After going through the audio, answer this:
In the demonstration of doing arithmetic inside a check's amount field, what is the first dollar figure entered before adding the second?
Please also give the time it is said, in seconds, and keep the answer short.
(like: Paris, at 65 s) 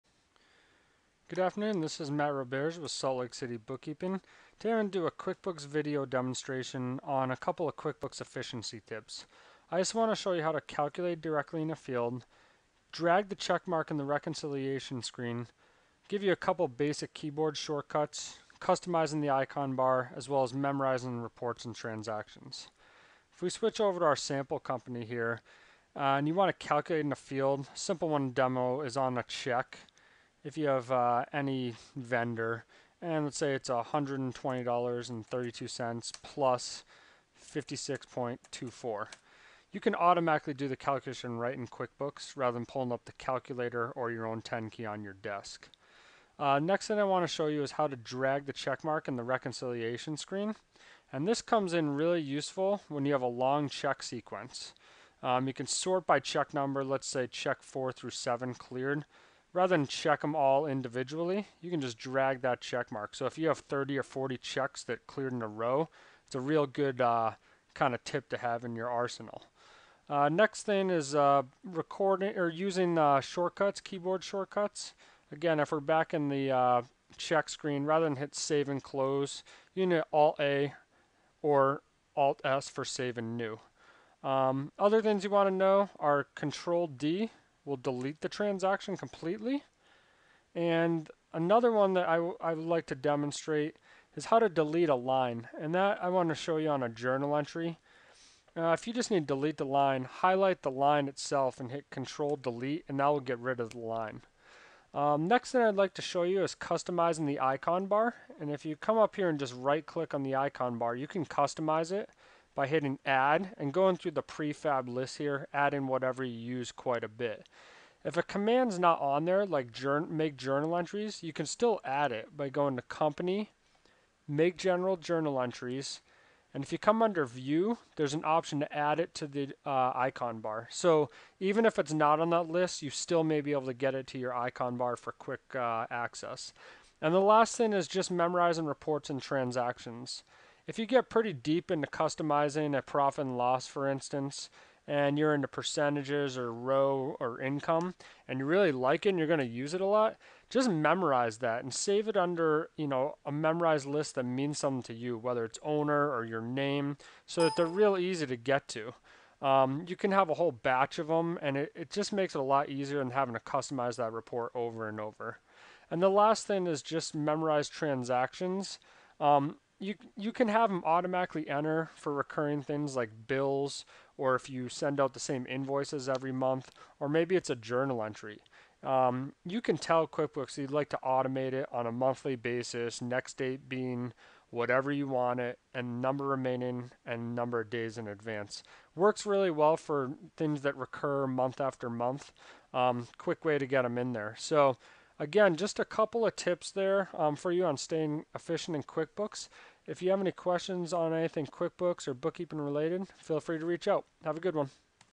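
$120.32, at 33 s.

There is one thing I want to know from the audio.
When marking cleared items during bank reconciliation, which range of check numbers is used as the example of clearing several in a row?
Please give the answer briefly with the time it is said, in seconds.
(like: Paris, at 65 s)
4 through 7, at 57 s.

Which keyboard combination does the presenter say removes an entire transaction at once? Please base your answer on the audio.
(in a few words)
Control D.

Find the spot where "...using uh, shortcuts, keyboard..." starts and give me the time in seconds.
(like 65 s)
72 s.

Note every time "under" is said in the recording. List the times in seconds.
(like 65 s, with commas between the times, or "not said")
127 s, 152 s.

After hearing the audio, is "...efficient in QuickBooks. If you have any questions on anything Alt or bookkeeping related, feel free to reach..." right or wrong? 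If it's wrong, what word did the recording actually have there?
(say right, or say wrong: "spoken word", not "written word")
wrong: "QuickBooks", not "Alt".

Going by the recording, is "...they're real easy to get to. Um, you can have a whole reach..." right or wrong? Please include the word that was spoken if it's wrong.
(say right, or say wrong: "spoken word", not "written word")
wrong: "batch", not "reach".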